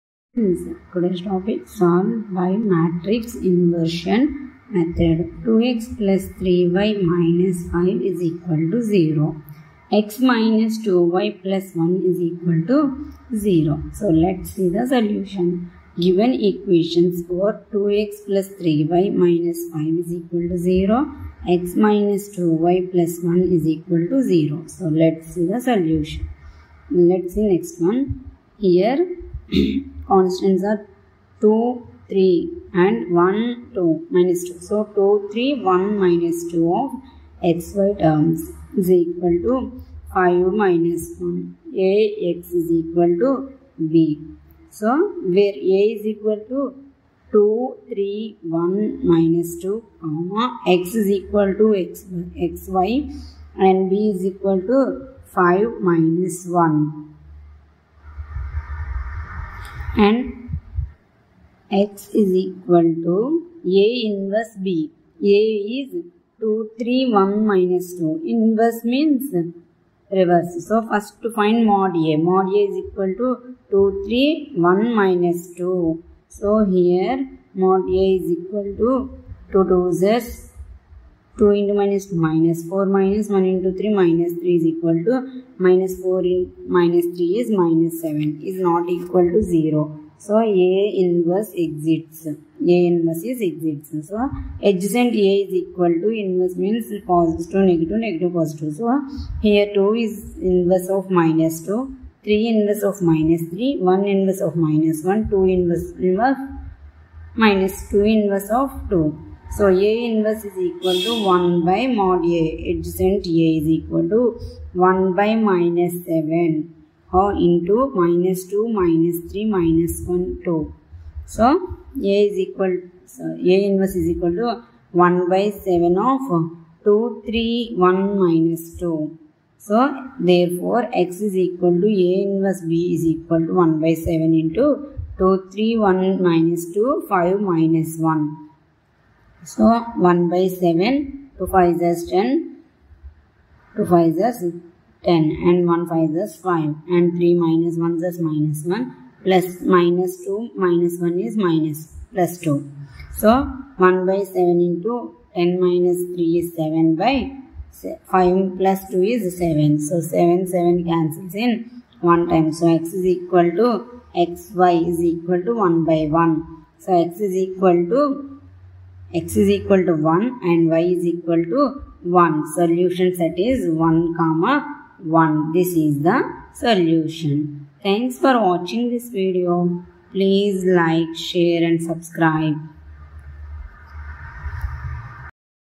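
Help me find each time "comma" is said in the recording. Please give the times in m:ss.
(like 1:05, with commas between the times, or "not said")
0:50, 2:54.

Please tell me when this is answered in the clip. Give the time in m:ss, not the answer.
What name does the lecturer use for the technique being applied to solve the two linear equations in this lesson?
0:02.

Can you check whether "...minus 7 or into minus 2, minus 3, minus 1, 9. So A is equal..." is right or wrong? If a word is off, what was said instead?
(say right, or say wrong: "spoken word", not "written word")
wrong: "2", not "9".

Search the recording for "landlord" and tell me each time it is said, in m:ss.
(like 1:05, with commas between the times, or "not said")
not said.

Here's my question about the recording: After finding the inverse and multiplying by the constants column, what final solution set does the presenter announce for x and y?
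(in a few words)
1, 1.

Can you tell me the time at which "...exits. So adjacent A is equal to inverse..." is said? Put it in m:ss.
1:33.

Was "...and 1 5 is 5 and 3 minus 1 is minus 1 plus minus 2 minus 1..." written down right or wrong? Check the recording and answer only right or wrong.
right.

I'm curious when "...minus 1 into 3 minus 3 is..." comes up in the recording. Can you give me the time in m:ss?
1:22.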